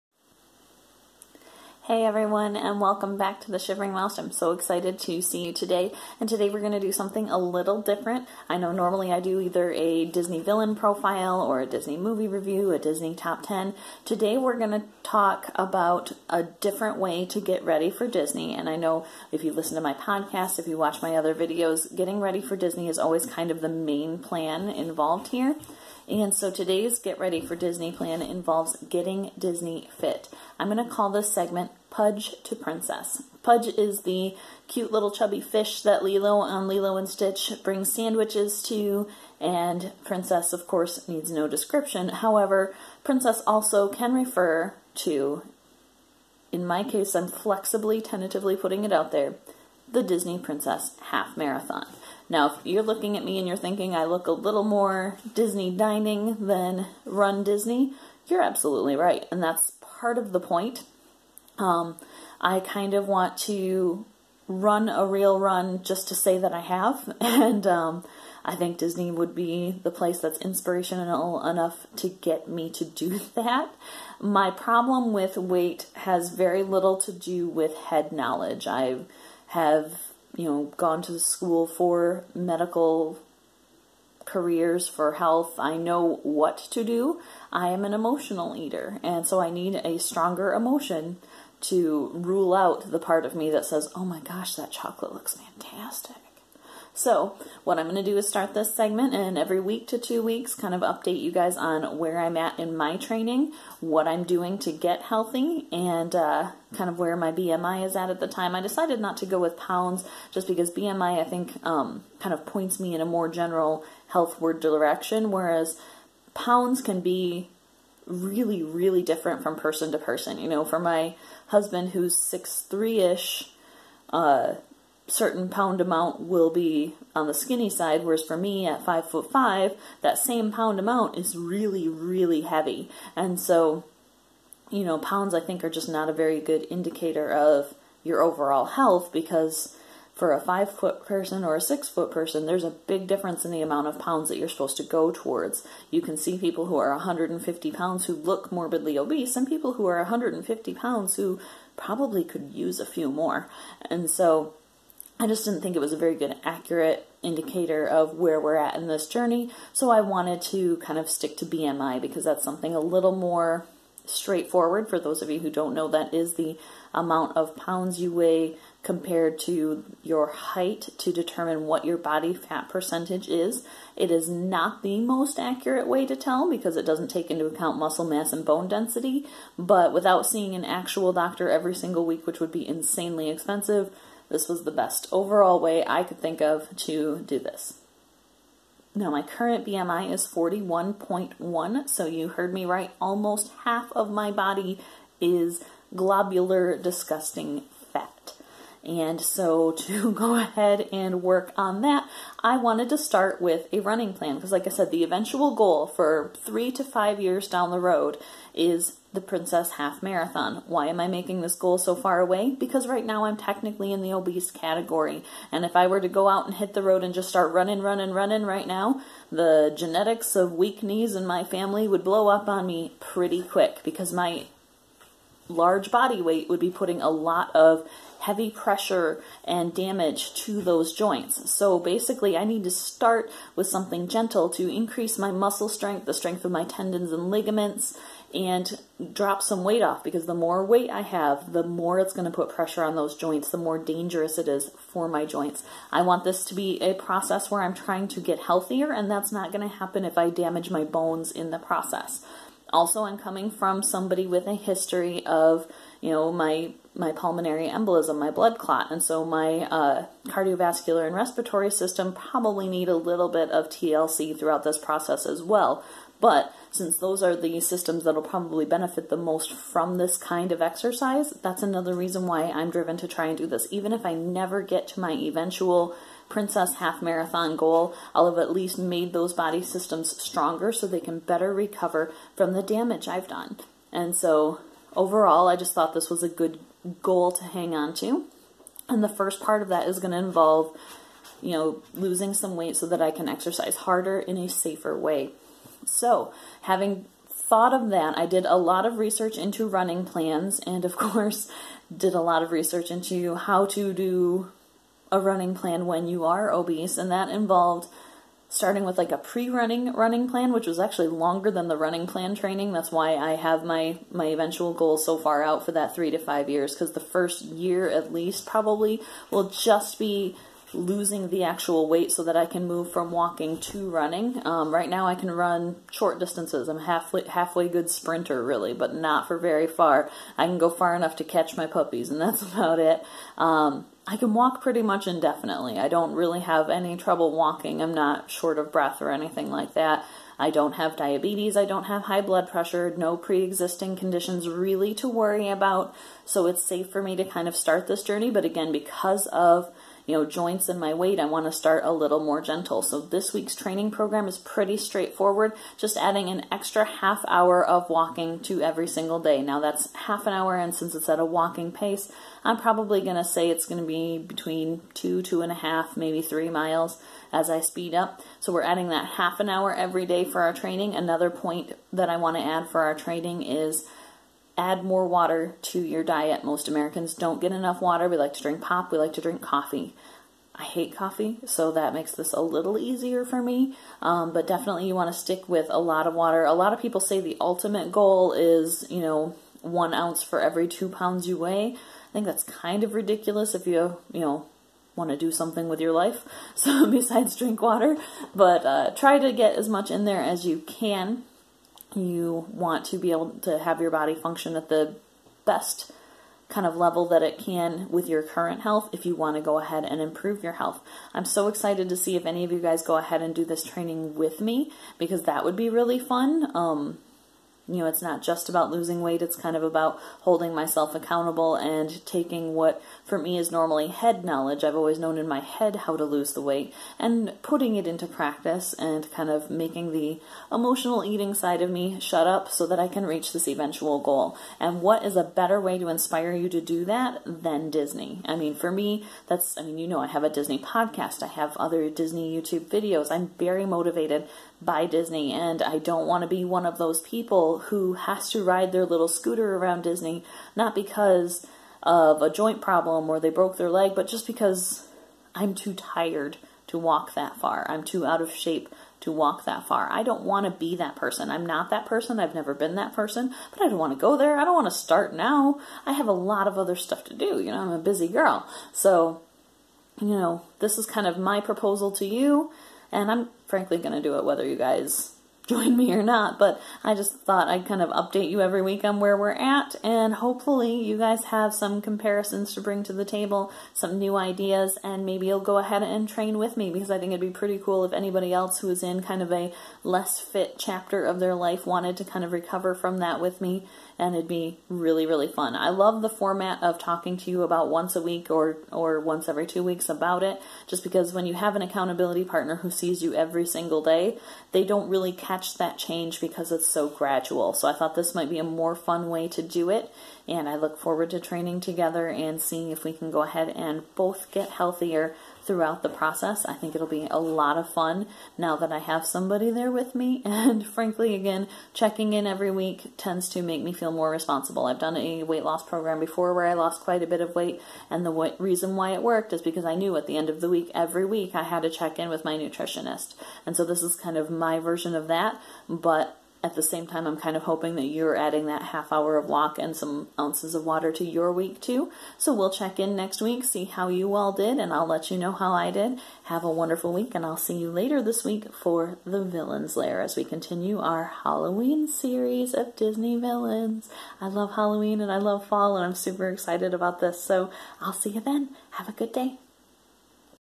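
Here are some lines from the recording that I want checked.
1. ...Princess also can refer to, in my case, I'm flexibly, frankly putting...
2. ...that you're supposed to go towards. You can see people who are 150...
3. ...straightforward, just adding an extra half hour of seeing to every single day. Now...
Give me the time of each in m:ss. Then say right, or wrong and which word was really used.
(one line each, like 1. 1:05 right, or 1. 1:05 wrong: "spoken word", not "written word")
1. 0:43 wrong: "tentatively", not "frankly"
2. 2:24 right
3. 5:54 wrong: "walking", not "seeing".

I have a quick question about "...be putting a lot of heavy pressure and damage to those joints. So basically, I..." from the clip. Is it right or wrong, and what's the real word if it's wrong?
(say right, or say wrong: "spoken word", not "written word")
right.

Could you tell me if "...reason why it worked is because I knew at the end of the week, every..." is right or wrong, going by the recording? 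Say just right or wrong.
right.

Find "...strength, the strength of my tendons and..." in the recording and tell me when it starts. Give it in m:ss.
3:55.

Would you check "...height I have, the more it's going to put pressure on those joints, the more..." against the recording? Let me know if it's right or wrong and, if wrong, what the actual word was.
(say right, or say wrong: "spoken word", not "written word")
wrong: "weight", not "height".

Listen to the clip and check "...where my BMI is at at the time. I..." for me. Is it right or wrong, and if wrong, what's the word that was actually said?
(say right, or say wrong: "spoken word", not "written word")
right.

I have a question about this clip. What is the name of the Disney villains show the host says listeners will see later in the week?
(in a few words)
The Villain's Lair.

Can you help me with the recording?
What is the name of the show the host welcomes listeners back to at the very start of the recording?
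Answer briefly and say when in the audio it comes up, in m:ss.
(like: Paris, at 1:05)
The Shivering Mouse, at 0:03.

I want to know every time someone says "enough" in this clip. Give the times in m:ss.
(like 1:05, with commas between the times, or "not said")
1:11, 5:30, 6:17.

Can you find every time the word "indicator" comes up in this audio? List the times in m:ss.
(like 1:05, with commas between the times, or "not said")
2:16, 2:37.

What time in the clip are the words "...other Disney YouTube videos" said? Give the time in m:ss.
7:21.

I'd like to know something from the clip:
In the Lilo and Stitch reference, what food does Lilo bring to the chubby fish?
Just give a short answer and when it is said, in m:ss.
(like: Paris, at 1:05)
Sandwiches, at 0:37.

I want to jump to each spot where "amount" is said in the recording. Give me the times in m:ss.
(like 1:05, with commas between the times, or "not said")
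2:05, 2:10, 2:23, 2:46.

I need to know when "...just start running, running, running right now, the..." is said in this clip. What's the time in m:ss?
3:37.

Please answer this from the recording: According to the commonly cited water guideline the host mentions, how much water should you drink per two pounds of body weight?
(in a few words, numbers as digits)
1 ounce.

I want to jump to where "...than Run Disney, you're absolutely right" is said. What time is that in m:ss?
0:56.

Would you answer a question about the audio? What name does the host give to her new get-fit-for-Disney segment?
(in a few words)
Pudge to Princess.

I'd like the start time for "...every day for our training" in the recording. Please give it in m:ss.
6:09.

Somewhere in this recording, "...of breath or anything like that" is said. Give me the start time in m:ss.
5:38.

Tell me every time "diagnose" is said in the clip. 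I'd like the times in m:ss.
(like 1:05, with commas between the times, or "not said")
not said.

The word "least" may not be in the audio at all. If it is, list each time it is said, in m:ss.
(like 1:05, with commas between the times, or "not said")
4:38, 5:18.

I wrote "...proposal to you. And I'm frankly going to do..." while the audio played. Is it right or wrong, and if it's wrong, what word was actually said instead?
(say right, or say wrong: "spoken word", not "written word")
right.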